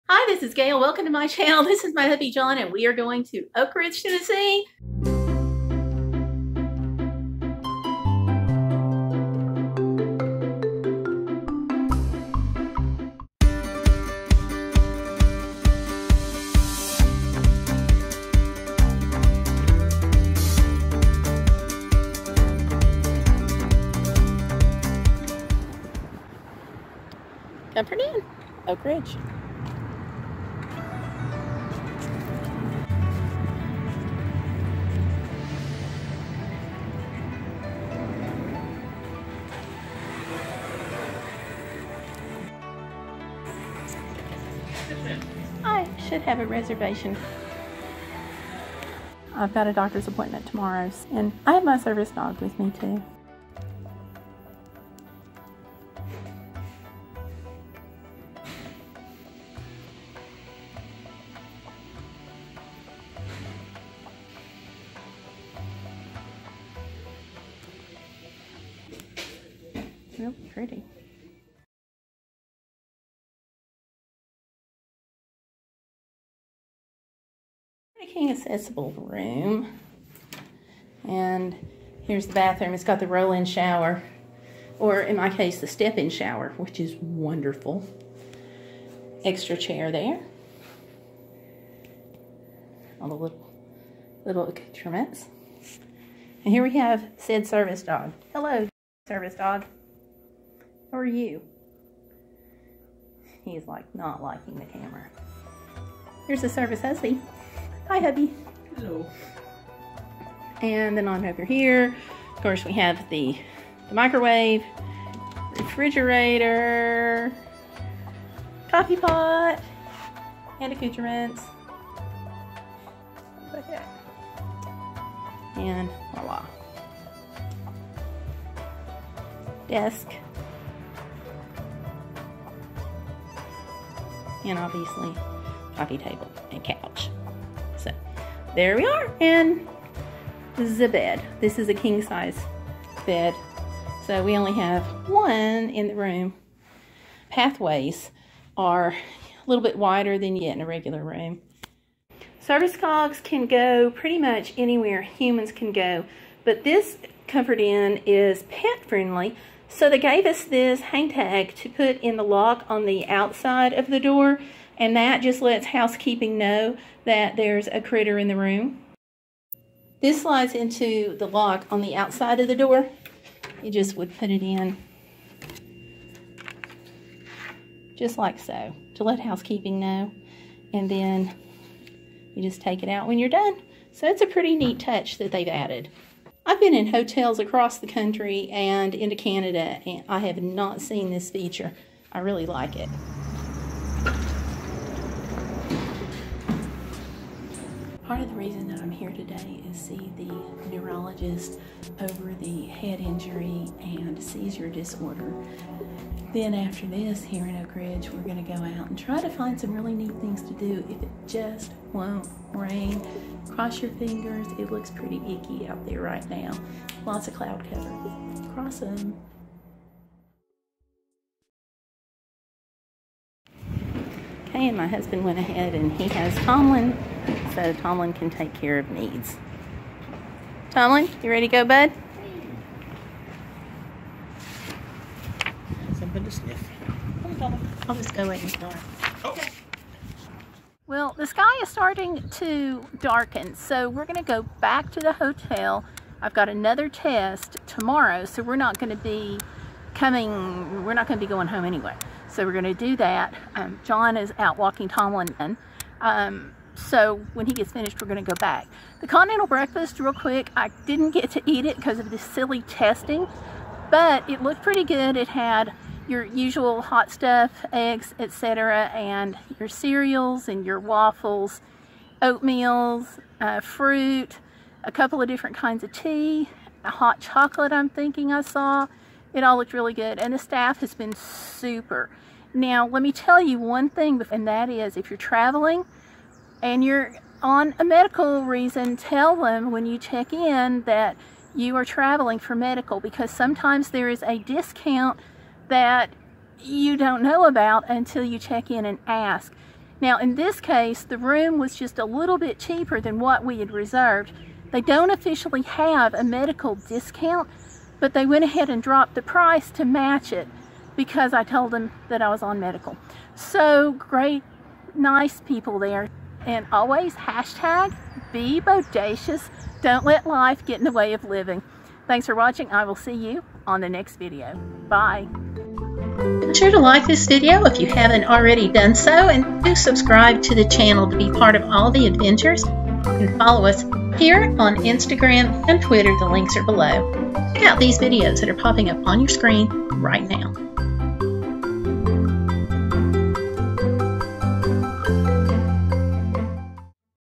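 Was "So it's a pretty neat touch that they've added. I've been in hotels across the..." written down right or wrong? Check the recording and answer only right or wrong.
right.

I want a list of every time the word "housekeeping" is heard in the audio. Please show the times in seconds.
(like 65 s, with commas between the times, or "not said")
165 s, 179 s.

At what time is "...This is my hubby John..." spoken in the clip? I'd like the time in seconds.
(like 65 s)
1 s.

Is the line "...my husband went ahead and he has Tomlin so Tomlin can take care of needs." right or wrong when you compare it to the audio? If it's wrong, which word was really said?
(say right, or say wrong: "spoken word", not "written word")
right.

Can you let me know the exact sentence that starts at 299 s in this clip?
Now in this case, the room was just a little bit cheaper than what we had reserved.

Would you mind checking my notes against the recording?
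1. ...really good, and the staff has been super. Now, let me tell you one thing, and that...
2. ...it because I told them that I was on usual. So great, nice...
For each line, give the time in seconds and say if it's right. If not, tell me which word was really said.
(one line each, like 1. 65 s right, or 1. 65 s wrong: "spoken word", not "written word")
1. 279 s right
2. 310 s wrong: "medical", not "usual".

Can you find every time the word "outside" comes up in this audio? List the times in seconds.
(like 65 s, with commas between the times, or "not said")
163 s, 171 s.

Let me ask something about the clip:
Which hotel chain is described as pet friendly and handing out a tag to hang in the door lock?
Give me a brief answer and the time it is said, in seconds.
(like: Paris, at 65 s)
Comfort Inn, at 157 s.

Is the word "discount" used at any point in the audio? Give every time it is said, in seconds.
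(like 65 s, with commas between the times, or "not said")
294 s, 306 s.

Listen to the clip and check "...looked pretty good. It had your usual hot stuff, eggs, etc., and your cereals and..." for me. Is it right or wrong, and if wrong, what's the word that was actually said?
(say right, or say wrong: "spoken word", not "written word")
right.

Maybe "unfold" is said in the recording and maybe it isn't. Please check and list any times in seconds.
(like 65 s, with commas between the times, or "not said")
not said.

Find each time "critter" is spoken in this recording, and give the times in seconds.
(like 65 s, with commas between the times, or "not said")
167 s.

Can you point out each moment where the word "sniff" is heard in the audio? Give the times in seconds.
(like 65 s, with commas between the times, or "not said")
236 s.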